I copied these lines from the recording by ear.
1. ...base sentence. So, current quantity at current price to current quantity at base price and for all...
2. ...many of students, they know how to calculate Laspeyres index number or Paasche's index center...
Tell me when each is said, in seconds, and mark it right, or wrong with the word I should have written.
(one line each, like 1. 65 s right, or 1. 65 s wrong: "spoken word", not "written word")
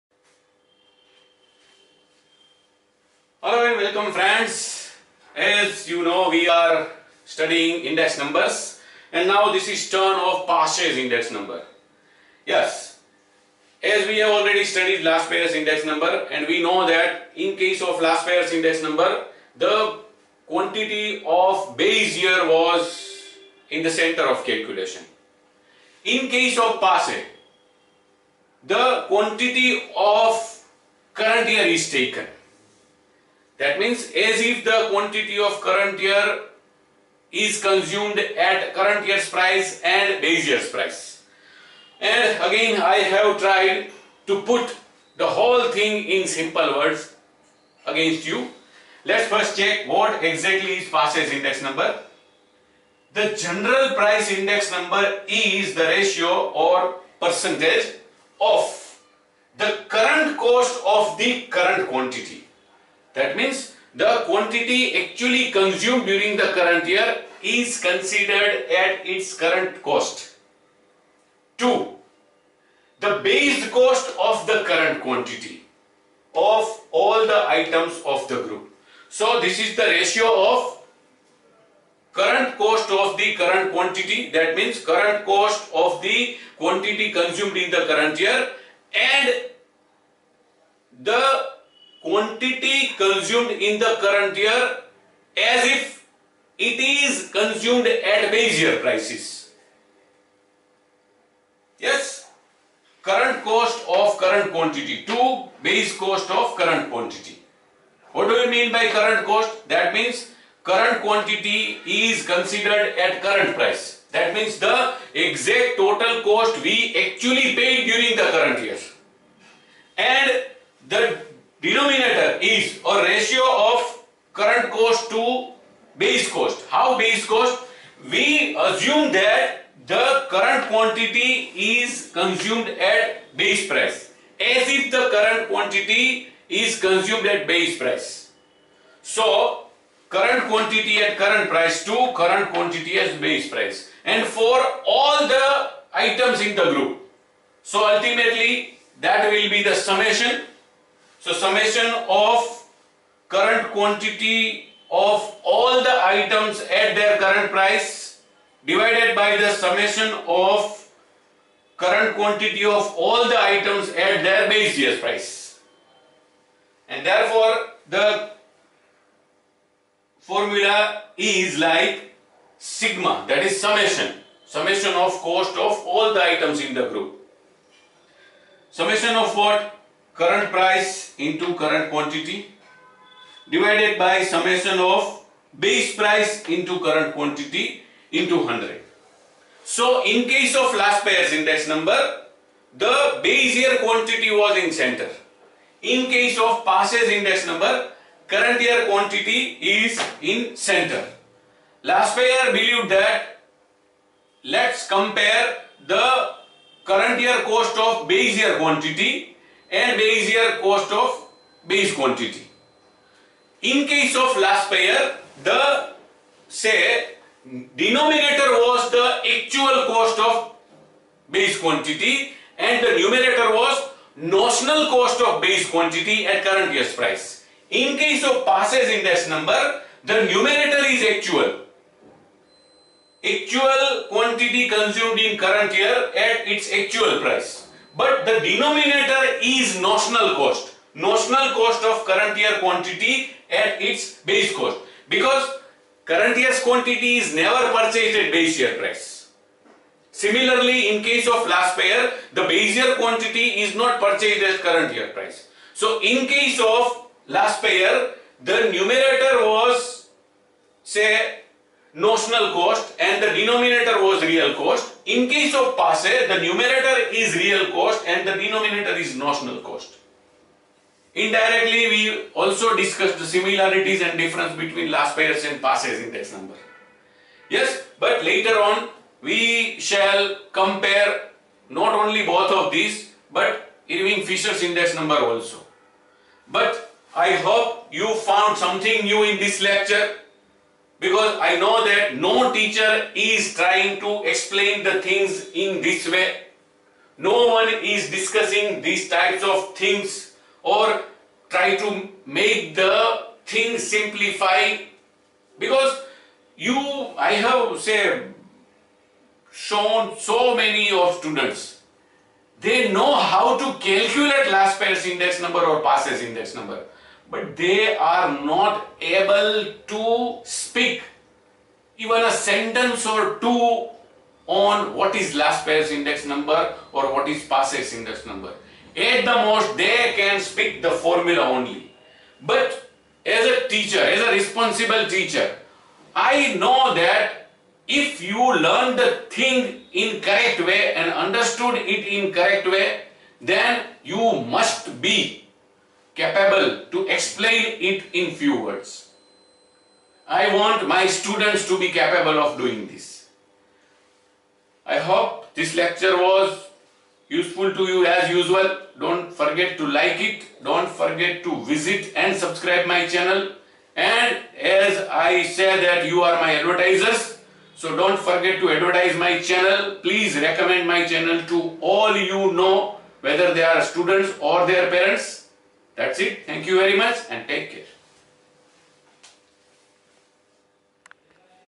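1. 137 s wrong: "price", not "sentence"
2. 310 s wrong: "number", not "center".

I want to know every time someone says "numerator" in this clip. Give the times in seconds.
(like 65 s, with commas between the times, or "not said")
222 s, 230 s, 258 s, 266 s.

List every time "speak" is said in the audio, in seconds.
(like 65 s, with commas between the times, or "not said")
320 s, 330 s.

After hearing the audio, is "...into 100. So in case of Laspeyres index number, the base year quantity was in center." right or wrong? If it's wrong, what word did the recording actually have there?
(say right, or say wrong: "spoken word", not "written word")
right.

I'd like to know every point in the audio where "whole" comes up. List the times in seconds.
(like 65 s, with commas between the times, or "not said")
45 s.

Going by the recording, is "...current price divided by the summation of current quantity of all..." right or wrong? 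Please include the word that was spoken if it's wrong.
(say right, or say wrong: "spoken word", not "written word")
right.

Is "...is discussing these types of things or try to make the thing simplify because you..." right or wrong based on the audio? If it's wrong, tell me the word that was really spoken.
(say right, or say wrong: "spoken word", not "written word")
right.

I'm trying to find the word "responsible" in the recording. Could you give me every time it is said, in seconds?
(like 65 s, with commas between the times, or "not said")
334 s.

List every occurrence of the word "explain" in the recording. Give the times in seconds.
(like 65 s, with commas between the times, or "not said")
294 s, 347 s.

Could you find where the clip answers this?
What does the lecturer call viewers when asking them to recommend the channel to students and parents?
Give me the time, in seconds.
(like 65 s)
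366 s.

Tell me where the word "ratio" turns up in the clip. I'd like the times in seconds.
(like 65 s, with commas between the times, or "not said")
55 s, 79 s, 123 s.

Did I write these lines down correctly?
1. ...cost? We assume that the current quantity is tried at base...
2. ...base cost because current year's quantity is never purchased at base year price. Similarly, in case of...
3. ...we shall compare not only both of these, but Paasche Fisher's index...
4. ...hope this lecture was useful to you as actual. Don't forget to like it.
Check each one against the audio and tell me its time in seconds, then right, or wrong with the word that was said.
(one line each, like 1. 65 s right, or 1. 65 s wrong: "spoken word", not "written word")
1. 127 s wrong: "consumed", not "tried"
2. 244 s right
3. 279 s wrong: "Irving", not "Paasche"
4. 354 s wrong: "usual", not "actual".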